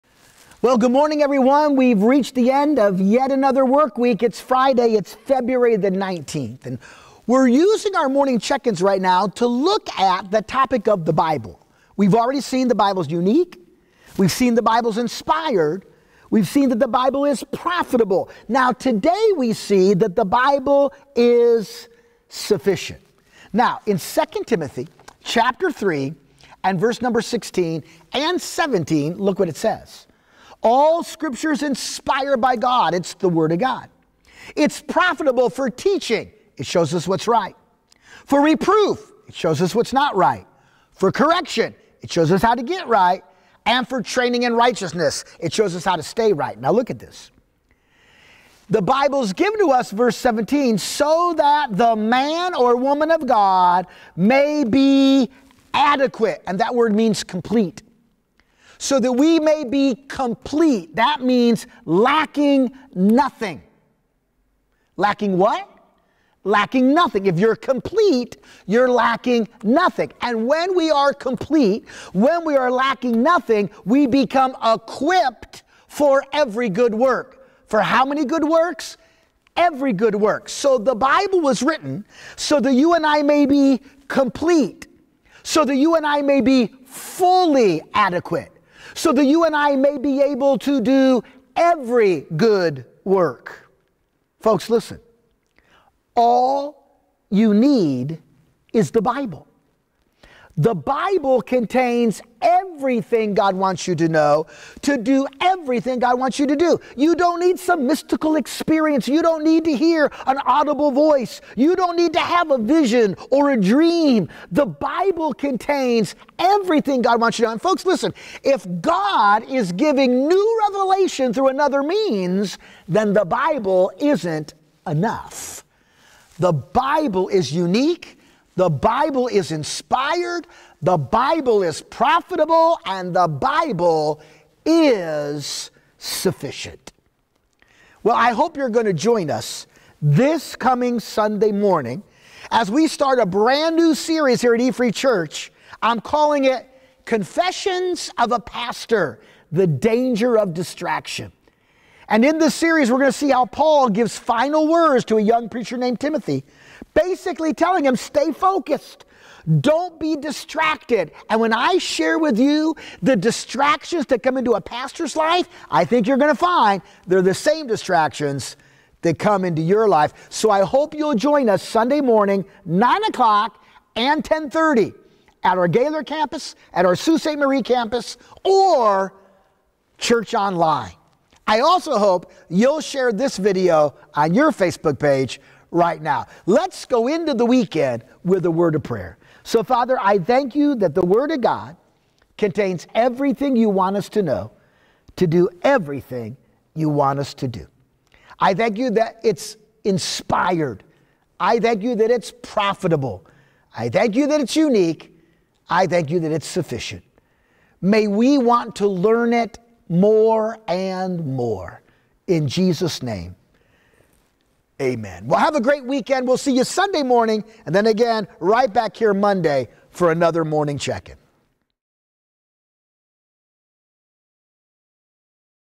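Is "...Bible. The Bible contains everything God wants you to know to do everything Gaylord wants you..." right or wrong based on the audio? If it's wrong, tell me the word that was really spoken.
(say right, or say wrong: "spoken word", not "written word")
wrong: "God", not "Gaylord".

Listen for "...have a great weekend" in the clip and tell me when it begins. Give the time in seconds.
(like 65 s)
215 s.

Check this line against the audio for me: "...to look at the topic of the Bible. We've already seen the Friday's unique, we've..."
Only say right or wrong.
wrong.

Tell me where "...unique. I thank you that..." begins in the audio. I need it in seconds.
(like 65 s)
204 s.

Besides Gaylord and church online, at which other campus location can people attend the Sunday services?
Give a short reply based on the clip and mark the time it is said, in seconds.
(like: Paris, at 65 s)
Sault Ste. 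Marie, at 176 s.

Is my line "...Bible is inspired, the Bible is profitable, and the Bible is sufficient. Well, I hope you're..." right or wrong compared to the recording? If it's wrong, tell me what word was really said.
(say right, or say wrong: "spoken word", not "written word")
right.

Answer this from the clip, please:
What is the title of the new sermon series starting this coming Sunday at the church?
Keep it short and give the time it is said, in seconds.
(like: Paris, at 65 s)
Confessions of a Pastor, at 147 s.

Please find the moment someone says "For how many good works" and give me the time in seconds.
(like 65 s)
77 s.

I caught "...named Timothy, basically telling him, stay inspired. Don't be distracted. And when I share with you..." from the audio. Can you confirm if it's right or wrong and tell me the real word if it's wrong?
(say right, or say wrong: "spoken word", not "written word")
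wrong: "focused", not "inspired".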